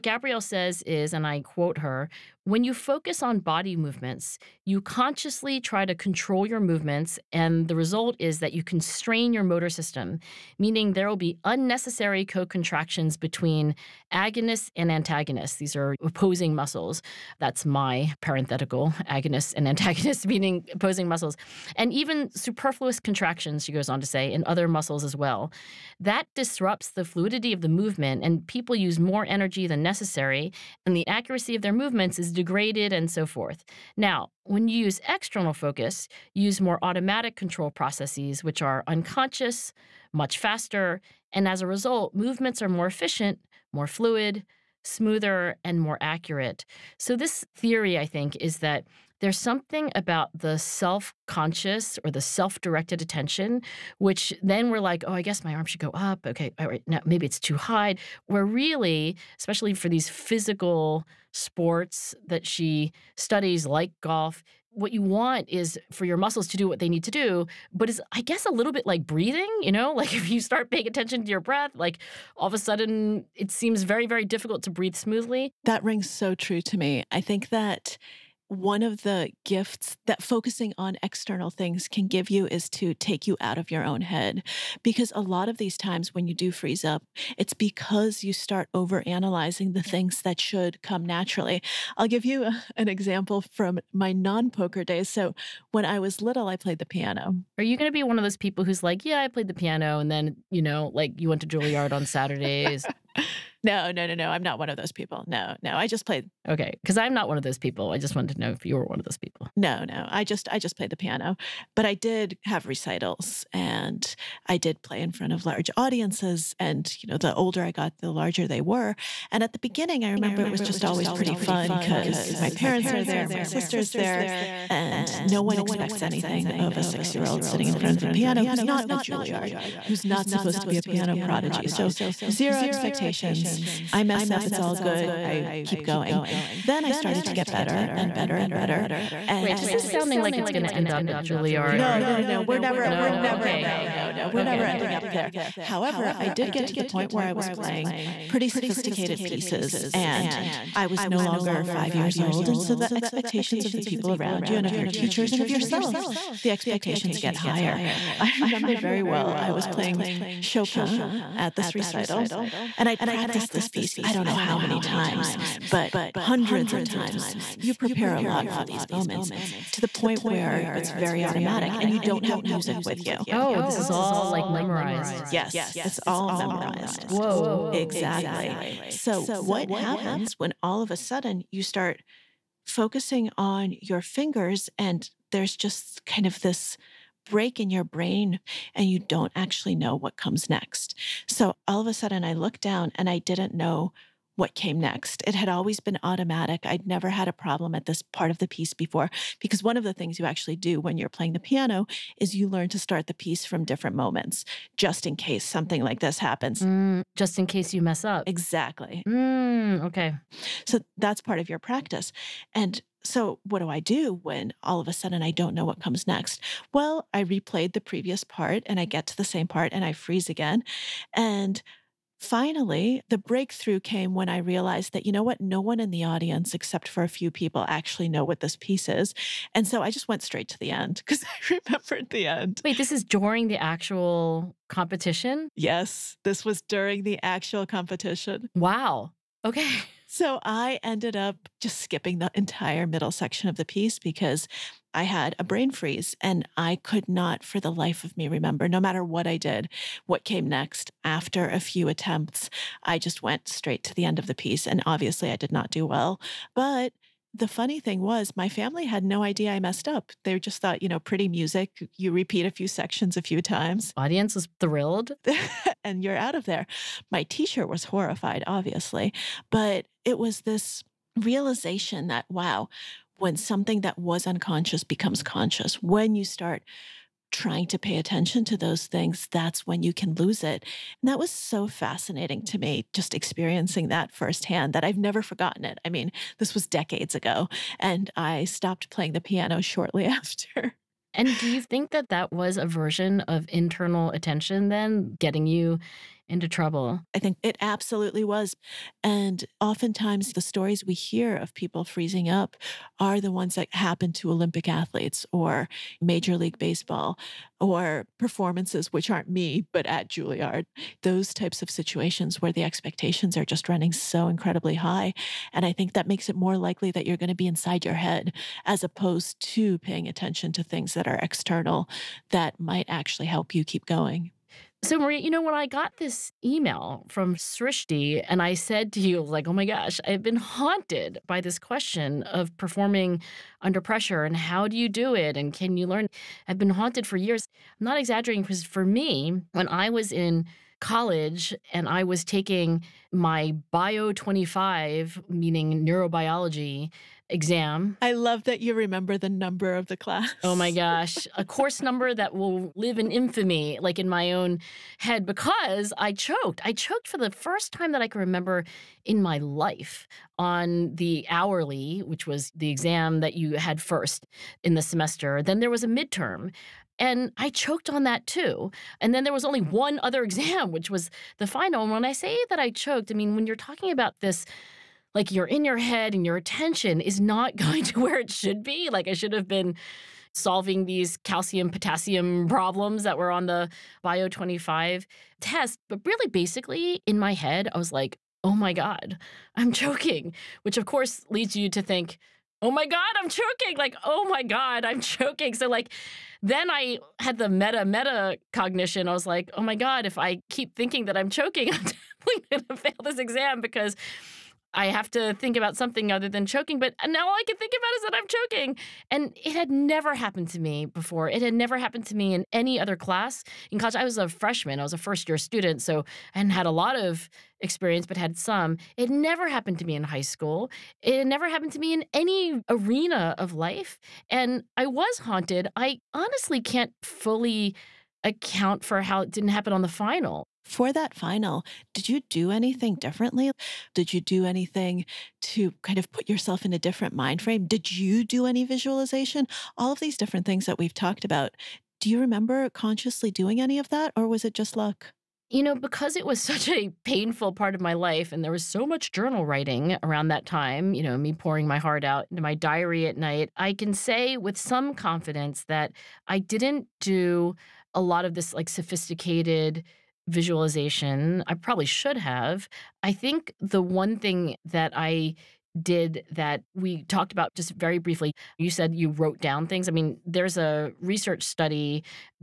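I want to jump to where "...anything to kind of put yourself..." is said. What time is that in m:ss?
7:14.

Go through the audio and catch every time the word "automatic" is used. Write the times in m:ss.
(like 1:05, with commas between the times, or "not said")
0:36, 2:51, 3:16.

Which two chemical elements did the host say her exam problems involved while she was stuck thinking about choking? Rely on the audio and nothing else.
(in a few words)
calcium potassium.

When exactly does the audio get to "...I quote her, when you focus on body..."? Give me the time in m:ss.
0:01.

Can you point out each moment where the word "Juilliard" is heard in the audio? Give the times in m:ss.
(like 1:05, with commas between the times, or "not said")
1:41, 2:09, 2:21, 5:10.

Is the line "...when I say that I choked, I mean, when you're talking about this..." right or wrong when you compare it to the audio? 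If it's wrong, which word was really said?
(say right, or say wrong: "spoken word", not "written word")
right.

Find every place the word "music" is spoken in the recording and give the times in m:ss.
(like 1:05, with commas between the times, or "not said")
2:52, 4:21.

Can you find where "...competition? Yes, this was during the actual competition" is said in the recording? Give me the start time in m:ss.
3:54.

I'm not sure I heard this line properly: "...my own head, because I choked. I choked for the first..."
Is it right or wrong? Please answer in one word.
right.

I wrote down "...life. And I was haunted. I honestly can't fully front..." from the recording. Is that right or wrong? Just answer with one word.
wrong.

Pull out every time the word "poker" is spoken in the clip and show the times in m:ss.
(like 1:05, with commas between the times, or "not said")
1:34.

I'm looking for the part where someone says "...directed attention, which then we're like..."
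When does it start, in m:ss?
0:52.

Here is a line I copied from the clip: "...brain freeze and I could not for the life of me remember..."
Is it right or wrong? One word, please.
right.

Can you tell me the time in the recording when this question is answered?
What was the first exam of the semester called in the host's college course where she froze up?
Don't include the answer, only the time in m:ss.
6:01.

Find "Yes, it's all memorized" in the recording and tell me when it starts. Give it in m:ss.
2:55.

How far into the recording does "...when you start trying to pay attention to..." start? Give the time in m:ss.
4:35.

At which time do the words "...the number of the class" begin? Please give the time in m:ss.
5:49.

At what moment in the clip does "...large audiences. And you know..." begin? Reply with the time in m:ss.
1:55.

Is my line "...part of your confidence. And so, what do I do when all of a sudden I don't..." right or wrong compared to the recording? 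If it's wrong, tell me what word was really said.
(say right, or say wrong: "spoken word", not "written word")
wrong: "practice", not "confidence".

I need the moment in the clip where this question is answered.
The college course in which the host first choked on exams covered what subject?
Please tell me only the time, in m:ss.
5:45.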